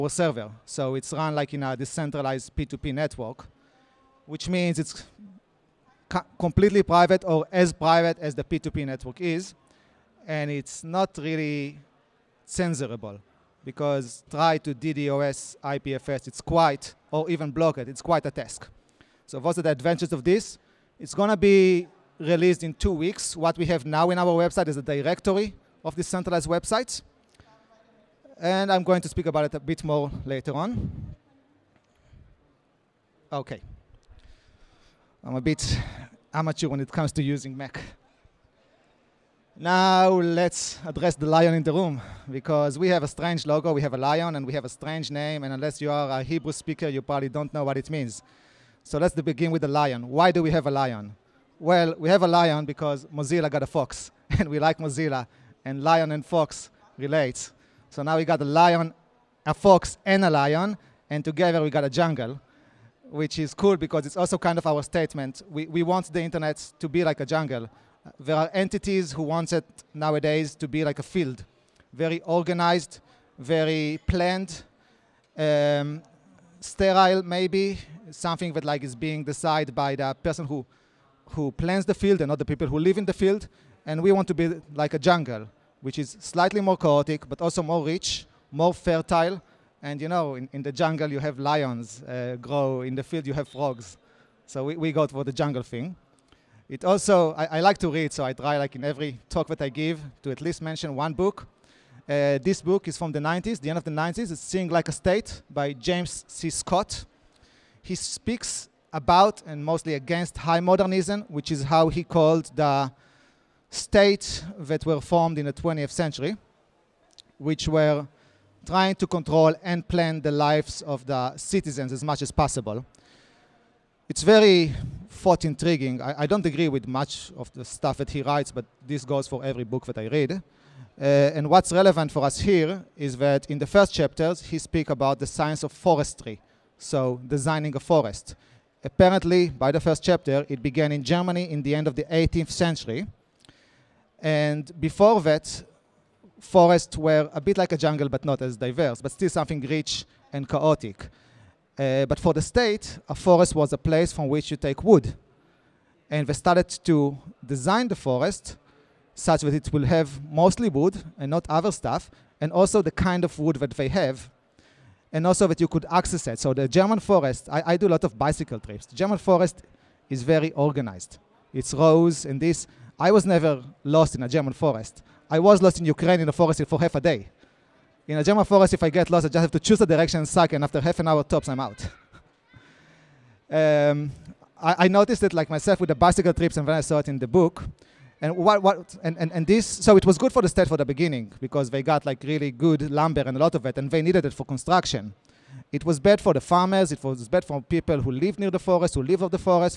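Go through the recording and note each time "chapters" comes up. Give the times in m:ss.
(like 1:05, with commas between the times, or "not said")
2:13, 2:20.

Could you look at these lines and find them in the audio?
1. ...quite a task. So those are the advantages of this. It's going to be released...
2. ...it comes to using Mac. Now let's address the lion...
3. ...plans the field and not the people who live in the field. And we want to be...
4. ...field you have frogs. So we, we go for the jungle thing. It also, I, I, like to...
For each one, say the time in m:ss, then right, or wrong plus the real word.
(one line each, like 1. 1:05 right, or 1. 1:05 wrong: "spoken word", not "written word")
1. 0:18 right
2. 0:36 right
3. 1:21 right
4. 1:33 right.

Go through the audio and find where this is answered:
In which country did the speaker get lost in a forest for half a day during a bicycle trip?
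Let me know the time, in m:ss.
2:55.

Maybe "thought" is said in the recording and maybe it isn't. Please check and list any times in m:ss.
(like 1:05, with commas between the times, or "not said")
2:05.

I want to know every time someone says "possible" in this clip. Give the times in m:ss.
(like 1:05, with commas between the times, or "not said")
2:02.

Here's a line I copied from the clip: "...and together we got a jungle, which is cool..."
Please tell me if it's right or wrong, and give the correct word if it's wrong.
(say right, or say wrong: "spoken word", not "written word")
right.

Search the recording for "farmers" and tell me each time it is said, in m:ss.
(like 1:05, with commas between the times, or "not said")
3:16.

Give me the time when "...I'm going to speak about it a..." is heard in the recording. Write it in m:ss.
0:28.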